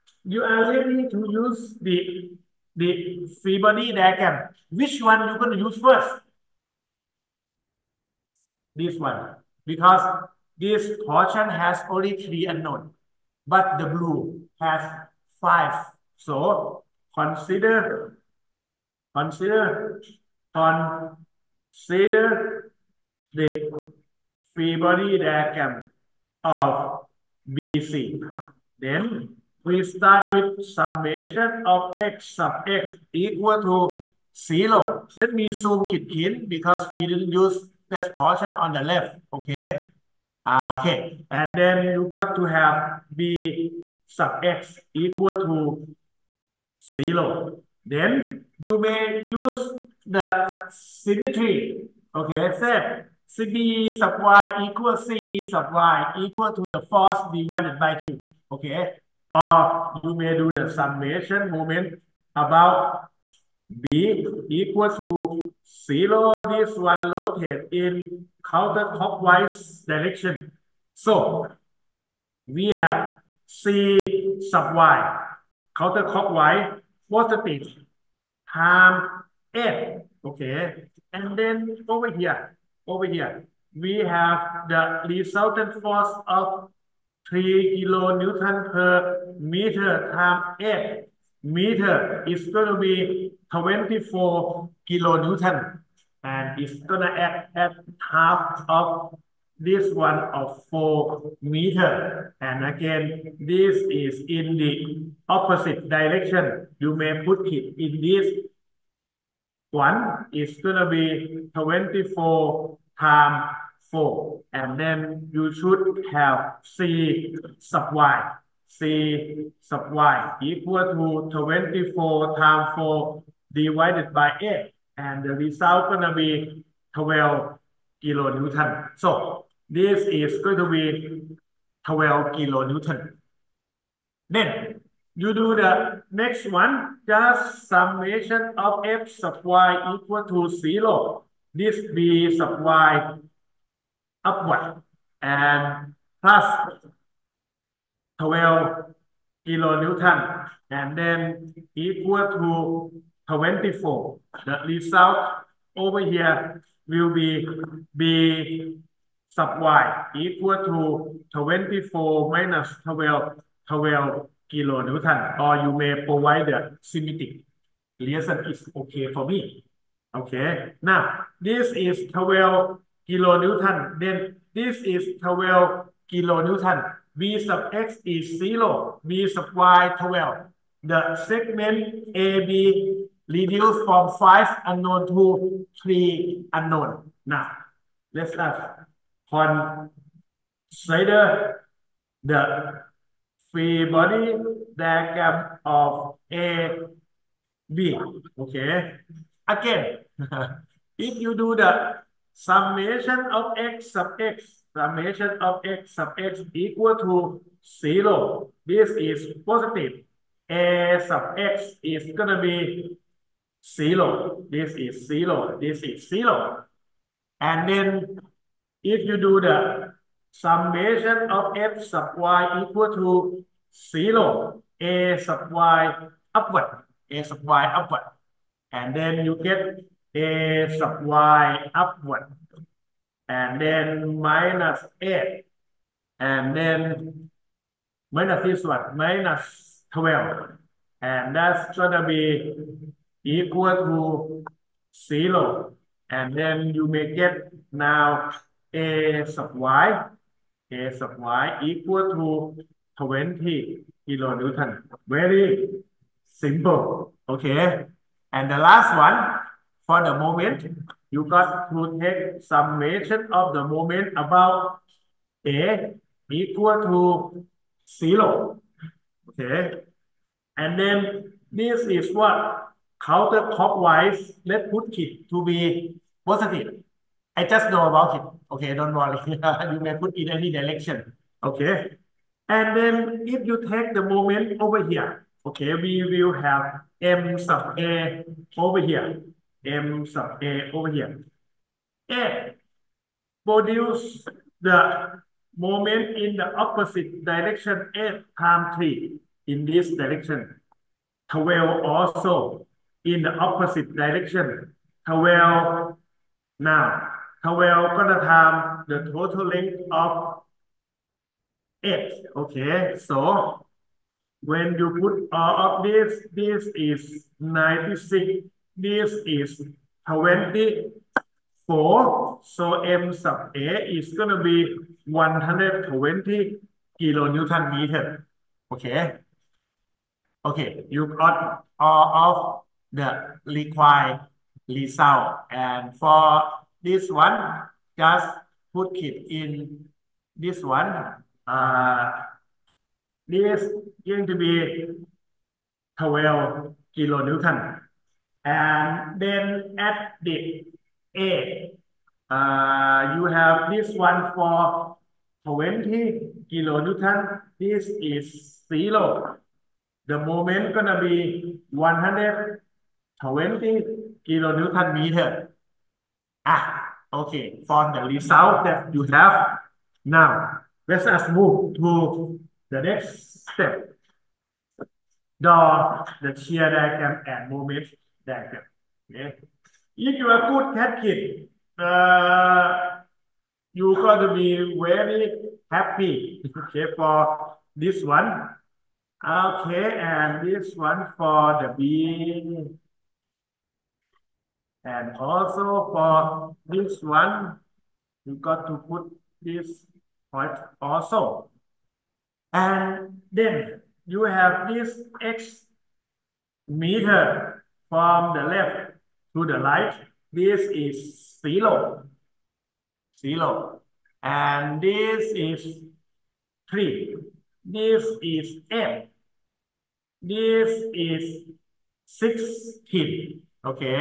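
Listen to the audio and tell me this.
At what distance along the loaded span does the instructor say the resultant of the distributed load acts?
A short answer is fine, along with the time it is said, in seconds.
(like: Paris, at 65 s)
4 meter, at 100 s.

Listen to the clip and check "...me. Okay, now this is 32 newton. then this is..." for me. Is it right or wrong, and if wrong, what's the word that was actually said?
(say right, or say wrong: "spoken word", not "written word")
wrong: "12", not "32".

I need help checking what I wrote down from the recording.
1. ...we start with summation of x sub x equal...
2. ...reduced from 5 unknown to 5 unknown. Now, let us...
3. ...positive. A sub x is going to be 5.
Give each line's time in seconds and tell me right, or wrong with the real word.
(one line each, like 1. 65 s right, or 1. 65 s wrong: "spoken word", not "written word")
1. 29 s right
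2. 183 s wrong: "3", not "5"
3. 209 s wrong: "0", not "5".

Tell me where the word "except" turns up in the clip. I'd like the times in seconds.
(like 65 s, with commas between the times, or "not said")
52 s.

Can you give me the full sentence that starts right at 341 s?
Uh, this is going to be 12 kilonewton.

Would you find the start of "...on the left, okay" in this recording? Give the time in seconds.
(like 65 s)
38 s.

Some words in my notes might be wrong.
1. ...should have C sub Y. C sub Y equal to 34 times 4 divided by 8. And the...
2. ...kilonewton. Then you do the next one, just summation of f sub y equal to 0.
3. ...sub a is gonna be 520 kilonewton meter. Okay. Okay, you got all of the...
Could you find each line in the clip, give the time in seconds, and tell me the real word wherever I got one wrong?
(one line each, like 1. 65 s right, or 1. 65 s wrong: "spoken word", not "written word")
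1. 115 s wrong: "24", not "34"
2. 132 s right
3. 323 s wrong: "120", not "520".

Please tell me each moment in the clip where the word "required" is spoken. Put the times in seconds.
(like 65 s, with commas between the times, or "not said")
333 s.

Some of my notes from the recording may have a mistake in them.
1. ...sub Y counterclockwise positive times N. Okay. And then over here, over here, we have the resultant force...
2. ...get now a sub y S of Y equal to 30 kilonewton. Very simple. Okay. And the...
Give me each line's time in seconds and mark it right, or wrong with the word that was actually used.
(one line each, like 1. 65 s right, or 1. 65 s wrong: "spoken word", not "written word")
1. 74 s right
2. 247 s wrong: "20", not "30".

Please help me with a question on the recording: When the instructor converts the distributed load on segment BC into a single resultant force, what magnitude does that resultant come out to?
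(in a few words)
24 kilonewton.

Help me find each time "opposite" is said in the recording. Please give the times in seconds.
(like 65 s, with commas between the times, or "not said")
105 s, 296 s, 303 s.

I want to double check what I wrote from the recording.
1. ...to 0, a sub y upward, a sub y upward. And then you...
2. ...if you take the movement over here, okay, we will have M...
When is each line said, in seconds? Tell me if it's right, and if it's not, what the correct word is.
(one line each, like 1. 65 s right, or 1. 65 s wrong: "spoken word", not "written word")
1. 222 s right
2. 283 s wrong: "moment", not "movement".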